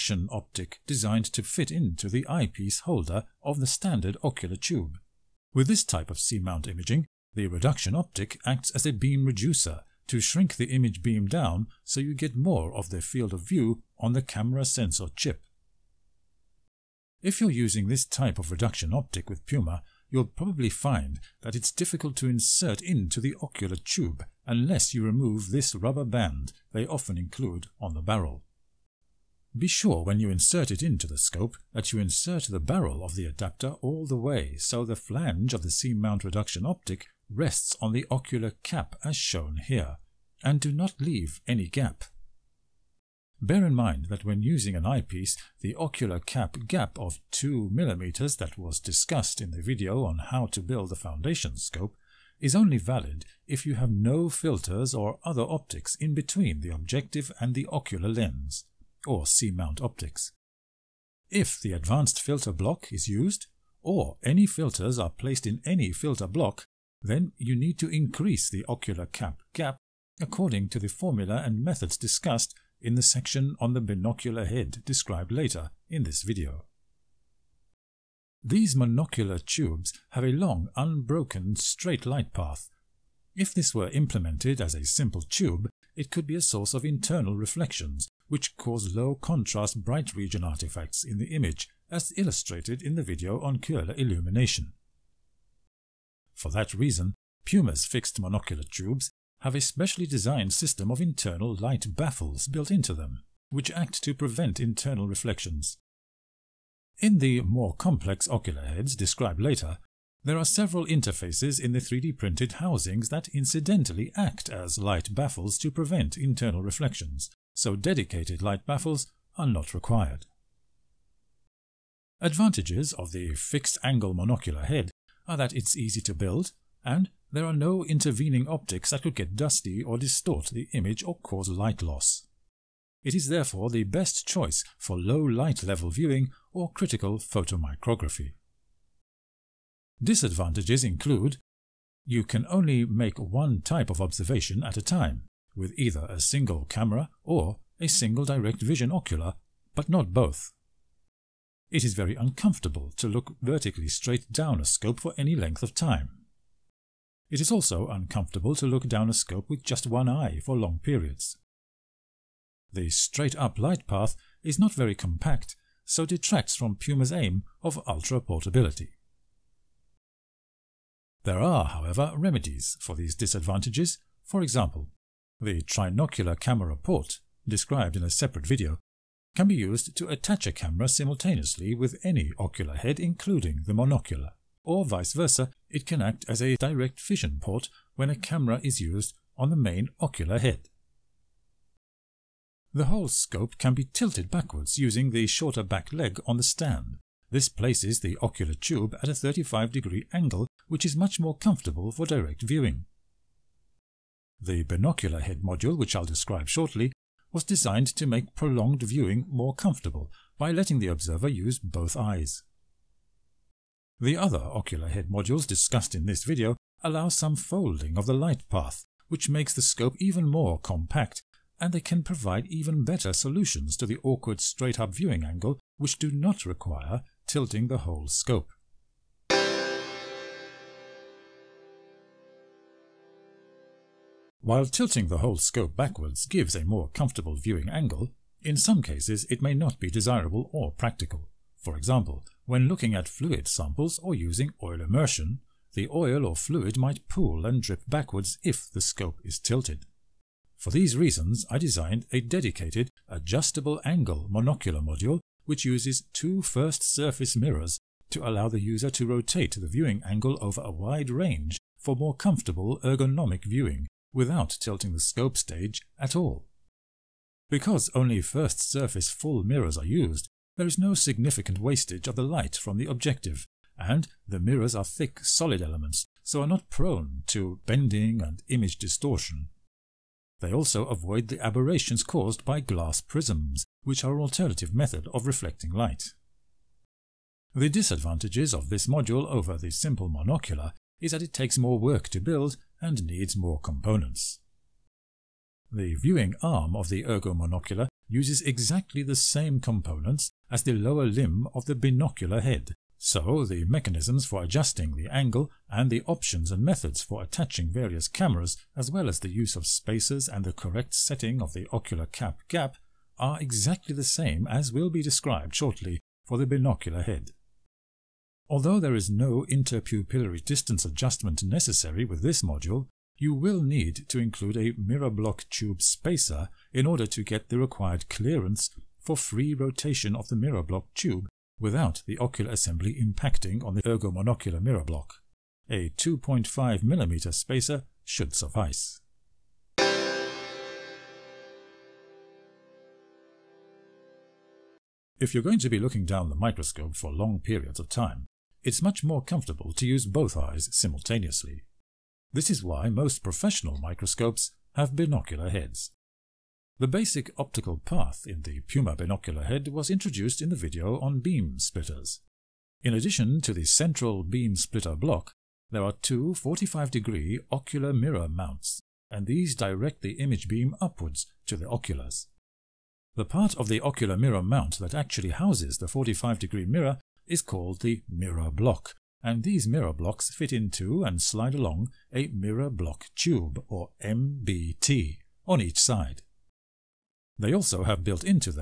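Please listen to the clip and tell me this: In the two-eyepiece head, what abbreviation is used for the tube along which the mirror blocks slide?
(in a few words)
MBT.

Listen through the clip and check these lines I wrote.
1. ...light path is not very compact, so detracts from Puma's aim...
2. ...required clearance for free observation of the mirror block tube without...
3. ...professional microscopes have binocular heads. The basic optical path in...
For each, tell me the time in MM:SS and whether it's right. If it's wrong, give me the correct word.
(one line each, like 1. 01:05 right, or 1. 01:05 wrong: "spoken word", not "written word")
1. 02:43 right
2. 05:27 wrong: "rotation", not "observation"
3. 05:53 right.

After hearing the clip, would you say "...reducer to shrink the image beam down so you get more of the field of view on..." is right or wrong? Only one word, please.
right.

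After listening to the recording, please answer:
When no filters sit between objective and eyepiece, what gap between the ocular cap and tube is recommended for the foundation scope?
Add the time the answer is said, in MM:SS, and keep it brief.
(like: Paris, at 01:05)
2 mm, at 00:47.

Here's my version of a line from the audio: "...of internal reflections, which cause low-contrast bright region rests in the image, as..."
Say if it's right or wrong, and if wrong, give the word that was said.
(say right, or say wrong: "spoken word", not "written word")
wrong: "artifacts", not "rests".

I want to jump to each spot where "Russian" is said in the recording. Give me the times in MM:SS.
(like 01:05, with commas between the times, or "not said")
not said.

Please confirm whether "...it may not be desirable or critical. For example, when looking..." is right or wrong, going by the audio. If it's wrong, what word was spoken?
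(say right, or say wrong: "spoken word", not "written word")
wrong: "practical", not "critical".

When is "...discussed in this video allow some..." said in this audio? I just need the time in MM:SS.
03:35.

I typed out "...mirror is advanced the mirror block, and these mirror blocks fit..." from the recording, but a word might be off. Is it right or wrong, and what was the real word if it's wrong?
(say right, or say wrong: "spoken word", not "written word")
wrong: "called", not "advanced".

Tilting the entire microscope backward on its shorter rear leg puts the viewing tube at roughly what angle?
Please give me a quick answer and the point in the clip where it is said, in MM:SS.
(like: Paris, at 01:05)
35 degrees, at 03:19.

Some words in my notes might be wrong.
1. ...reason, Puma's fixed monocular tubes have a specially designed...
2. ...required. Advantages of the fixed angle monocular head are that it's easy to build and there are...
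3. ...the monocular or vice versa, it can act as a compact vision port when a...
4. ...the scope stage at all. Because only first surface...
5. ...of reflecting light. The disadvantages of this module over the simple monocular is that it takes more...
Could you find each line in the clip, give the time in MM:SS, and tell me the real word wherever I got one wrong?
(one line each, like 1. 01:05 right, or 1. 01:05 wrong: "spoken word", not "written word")
1. 01:36 right
2. 01:59 right
3. 03:03 wrong: "direct", not "compact"
4. 04:24 right
5. 04:45 right.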